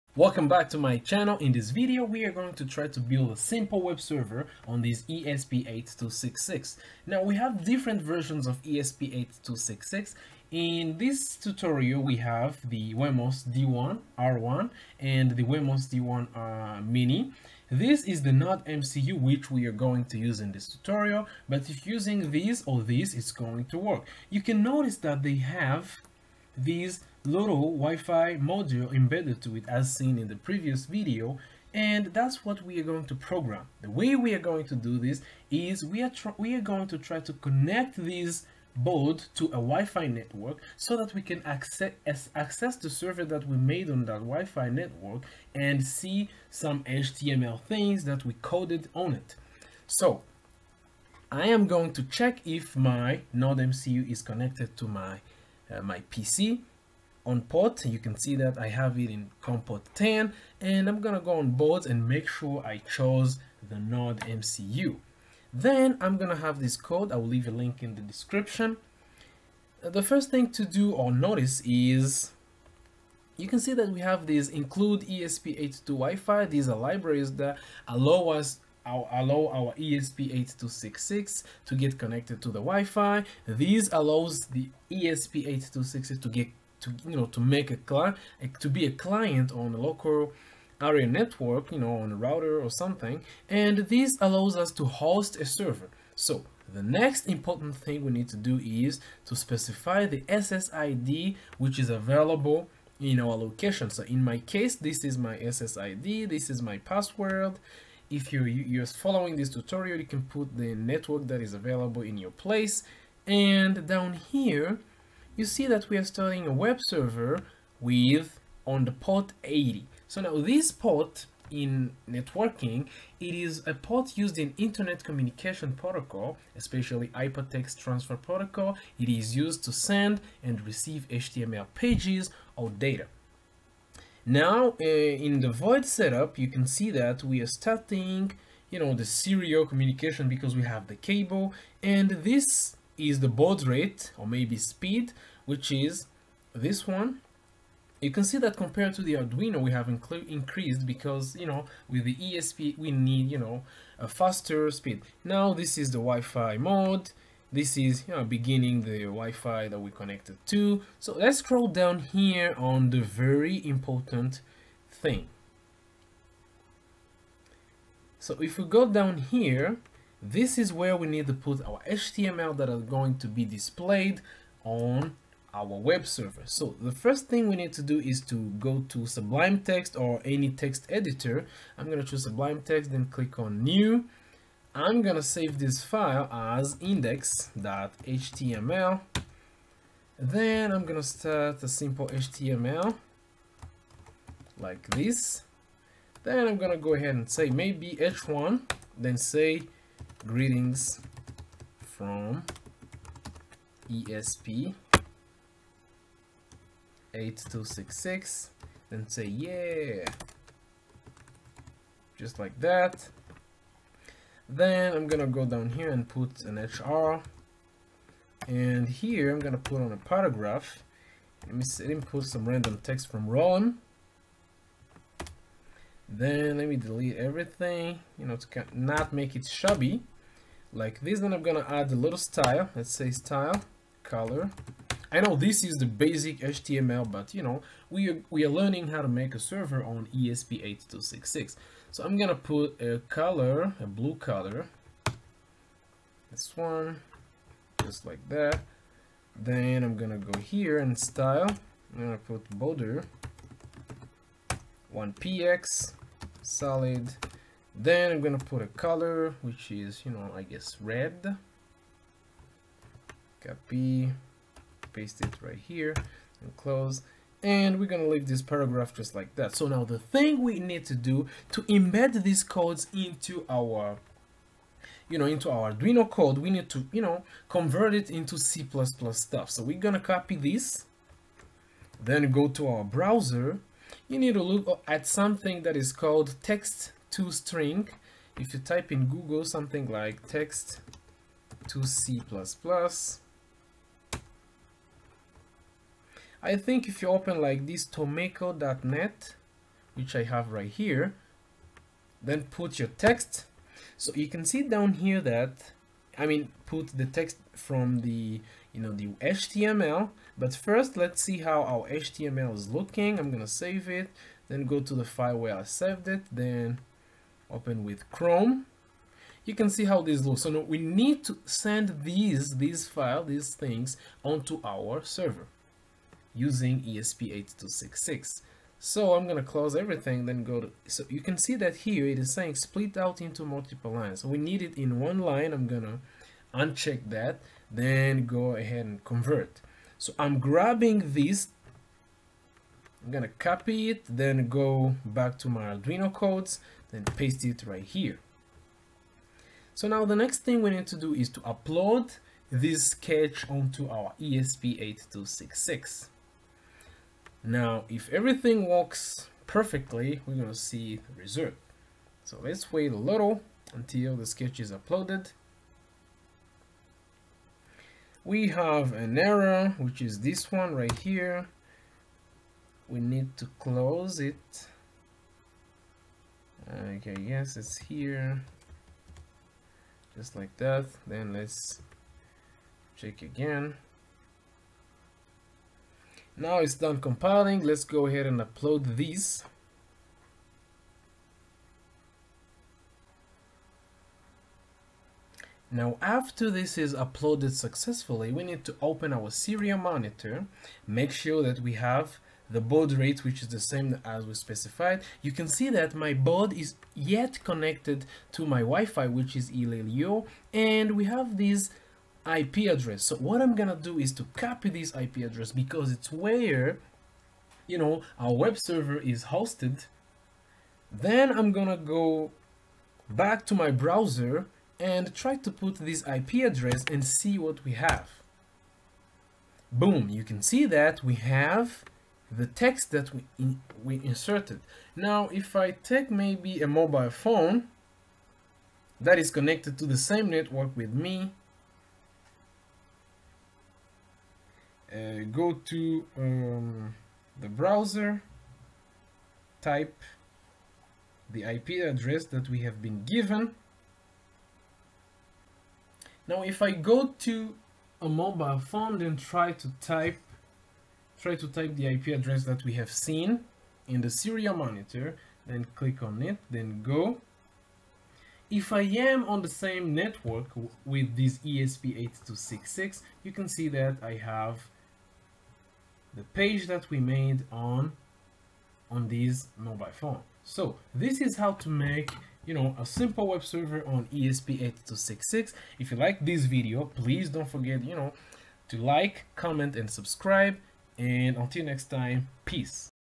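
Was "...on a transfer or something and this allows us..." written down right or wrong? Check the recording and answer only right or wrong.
wrong.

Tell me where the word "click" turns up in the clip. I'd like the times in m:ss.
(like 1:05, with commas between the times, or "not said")
3:03, 7:45.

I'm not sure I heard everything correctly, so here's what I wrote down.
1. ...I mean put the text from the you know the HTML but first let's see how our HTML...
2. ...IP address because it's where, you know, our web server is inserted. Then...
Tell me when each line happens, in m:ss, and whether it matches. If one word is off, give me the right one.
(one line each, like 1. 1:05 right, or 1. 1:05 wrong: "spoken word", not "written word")
1. 5:06 right
2. 6:54 wrong: "hosted", not "inserted".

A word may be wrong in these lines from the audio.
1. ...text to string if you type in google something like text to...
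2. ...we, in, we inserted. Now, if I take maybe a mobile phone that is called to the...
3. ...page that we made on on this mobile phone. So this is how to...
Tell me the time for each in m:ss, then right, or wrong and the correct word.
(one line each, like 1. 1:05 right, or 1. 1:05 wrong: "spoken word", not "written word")
1. 4:46 right
2. 7:13 wrong: "connected", not "called"
3. 7:56 right.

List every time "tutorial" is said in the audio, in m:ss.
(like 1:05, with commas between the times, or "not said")
0:11, 0:20, 1:49.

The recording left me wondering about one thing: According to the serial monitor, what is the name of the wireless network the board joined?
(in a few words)
Ilelio.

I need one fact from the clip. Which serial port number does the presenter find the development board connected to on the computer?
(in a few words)
COM port 10.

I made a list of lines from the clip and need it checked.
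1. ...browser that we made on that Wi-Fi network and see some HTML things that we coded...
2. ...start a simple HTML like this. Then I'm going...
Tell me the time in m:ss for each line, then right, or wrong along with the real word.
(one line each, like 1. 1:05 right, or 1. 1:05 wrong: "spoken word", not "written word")
1. 0:42 wrong: "server", not "browser"
2. 3:11 right.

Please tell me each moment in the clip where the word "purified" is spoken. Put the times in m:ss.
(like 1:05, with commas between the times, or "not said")
not said.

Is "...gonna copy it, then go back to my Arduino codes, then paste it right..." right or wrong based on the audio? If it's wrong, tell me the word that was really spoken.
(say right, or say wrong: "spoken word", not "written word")
right.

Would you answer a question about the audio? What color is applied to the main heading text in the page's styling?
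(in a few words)
blue.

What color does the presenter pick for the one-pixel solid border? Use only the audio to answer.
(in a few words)
red.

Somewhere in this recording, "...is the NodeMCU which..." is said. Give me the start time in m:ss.
0:18.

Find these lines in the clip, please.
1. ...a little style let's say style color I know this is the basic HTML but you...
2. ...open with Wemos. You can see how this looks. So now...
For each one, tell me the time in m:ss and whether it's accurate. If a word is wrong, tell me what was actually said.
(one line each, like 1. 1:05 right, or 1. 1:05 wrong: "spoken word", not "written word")
1. 3:51 right
2. 5:17 wrong: "Chrome", not "Wemos".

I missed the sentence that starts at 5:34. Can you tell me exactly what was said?
So we need it in one line, I'm gonna uncheck that, then go ahead and convert.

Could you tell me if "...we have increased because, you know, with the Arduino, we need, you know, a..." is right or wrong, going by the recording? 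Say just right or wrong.
wrong.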